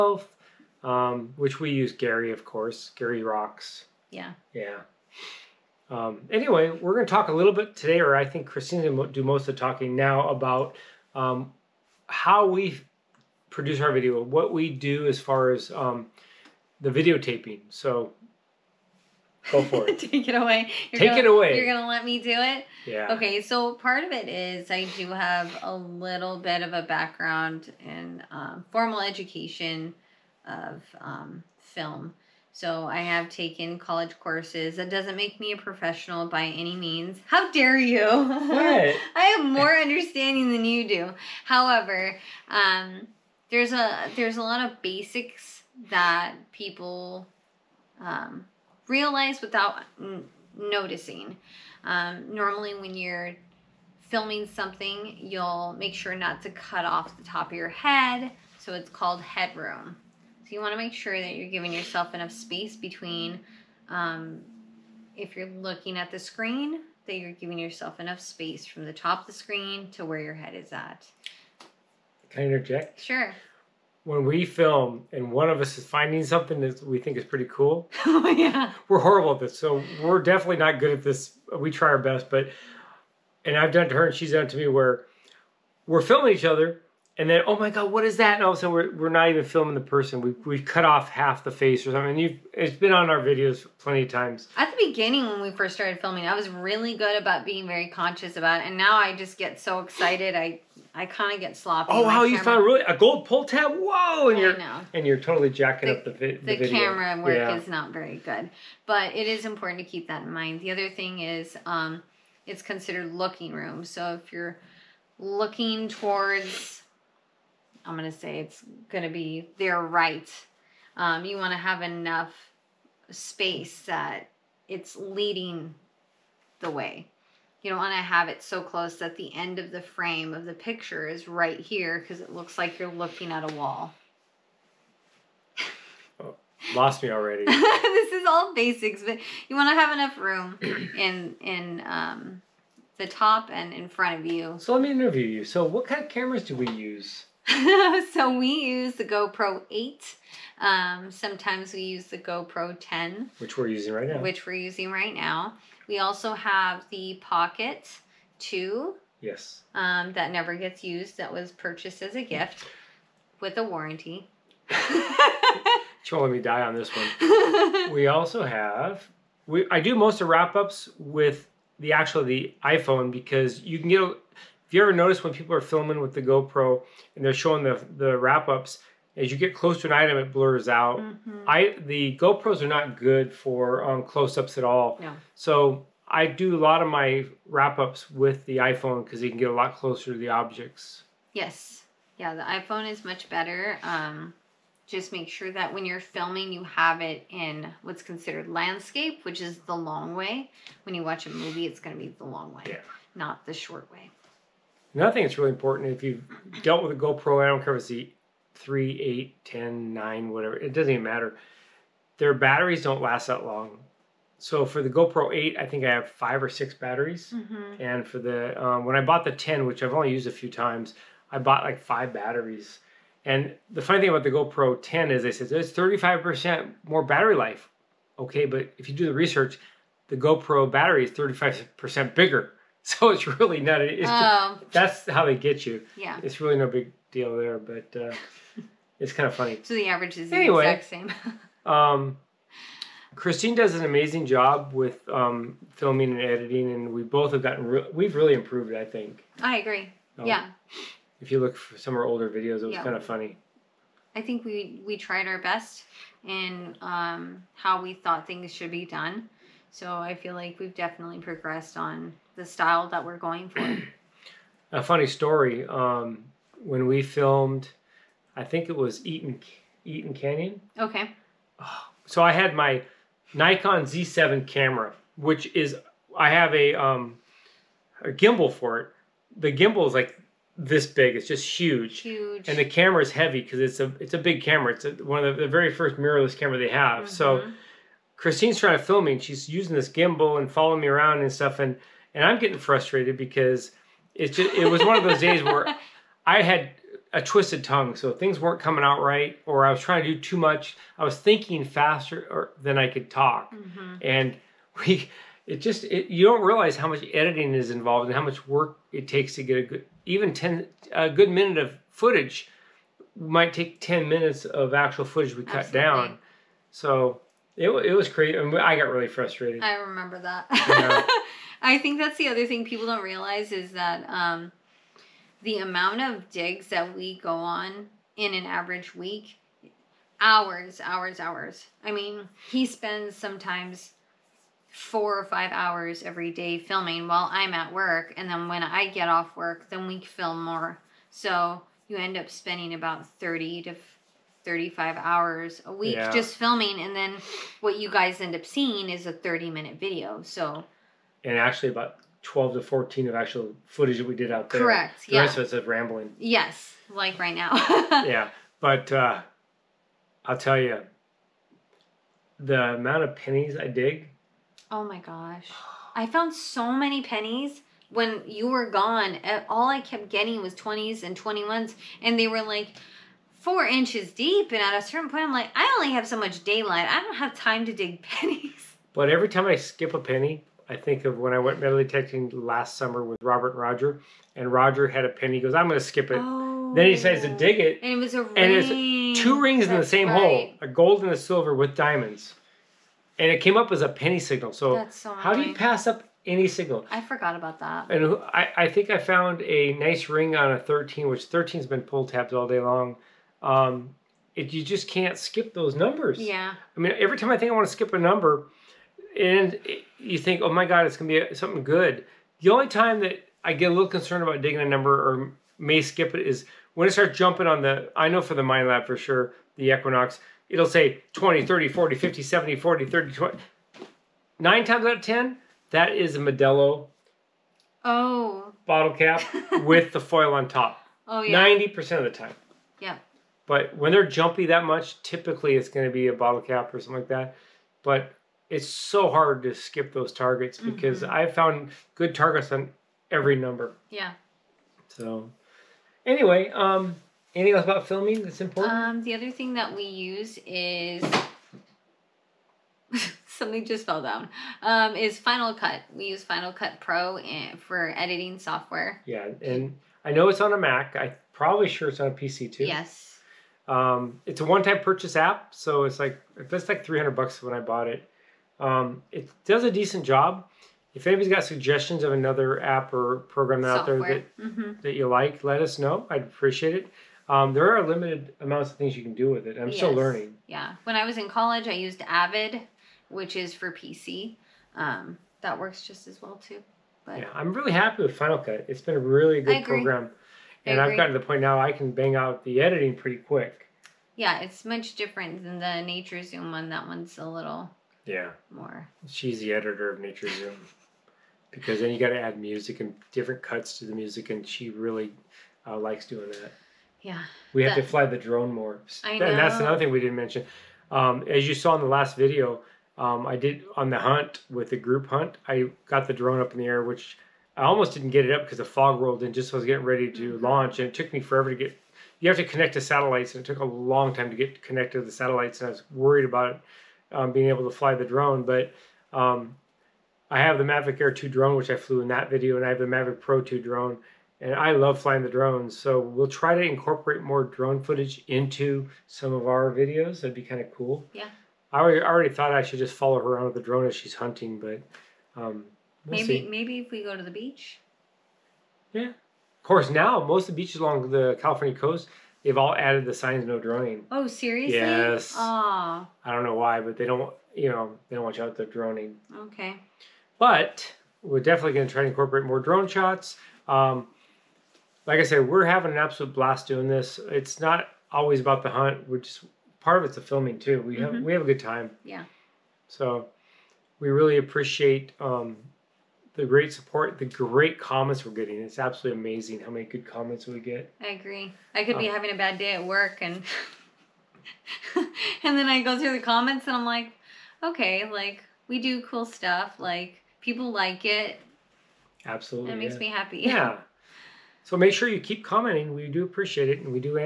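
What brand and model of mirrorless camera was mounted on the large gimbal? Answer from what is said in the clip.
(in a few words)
Nikon Z7.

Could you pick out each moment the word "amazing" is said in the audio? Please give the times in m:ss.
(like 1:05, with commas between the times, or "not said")
4:03, 9:39.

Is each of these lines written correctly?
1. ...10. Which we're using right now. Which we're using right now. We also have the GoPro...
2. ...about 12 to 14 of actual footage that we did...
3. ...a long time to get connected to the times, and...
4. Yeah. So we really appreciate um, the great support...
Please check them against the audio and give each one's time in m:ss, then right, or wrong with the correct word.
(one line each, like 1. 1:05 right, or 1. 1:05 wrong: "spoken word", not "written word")
1. 2:32 wrong: "Pocket", not "GoPro"
2. 5:51 right
3. 8:43 wrong: "satellites", not "times"
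4. 9:32 right.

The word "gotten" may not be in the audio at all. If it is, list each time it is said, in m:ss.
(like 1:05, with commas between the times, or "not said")
4:07, 8:10.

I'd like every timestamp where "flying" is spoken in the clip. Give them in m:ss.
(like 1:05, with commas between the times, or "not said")
8:54.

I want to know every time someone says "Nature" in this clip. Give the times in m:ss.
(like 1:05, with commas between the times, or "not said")
8:15, 8:19.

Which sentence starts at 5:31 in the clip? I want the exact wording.
I mean, he spends sometimes four or five hours every day filming while I'm at work.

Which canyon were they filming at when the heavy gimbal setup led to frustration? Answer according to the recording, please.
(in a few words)
Eaton Canyon.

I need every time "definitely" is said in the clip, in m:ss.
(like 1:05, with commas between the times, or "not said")
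1:20, 4:20, 9:21.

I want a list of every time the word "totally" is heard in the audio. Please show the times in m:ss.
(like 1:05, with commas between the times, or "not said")
1:45.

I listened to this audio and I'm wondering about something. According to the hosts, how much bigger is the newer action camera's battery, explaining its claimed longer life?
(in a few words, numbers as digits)
35%.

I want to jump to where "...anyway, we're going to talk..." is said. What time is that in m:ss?
0:06.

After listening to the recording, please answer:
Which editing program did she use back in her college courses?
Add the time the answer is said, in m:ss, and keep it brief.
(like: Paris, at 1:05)
Avid, at 8:02.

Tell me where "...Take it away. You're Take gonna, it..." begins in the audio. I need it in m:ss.
0:20.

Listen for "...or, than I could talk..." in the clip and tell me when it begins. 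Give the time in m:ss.
5:02.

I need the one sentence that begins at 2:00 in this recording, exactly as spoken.
Um, you want to have enough space that it's leading the way.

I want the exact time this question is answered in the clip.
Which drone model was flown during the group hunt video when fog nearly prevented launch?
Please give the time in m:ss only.
8:50.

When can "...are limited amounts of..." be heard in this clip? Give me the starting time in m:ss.
7:57.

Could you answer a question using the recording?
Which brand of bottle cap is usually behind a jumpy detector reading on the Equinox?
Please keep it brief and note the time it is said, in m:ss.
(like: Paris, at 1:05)
Modelo, at 7:06.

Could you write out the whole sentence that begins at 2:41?
That was purchased as a gift with a warranty.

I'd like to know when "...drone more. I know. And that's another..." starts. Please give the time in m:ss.
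8:28.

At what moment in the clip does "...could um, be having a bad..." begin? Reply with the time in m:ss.
9:41.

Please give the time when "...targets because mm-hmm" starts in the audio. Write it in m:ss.
7:20.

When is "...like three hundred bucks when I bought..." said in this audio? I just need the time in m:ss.
7:46.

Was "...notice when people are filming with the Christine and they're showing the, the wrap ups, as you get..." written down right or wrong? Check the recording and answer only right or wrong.
wrong.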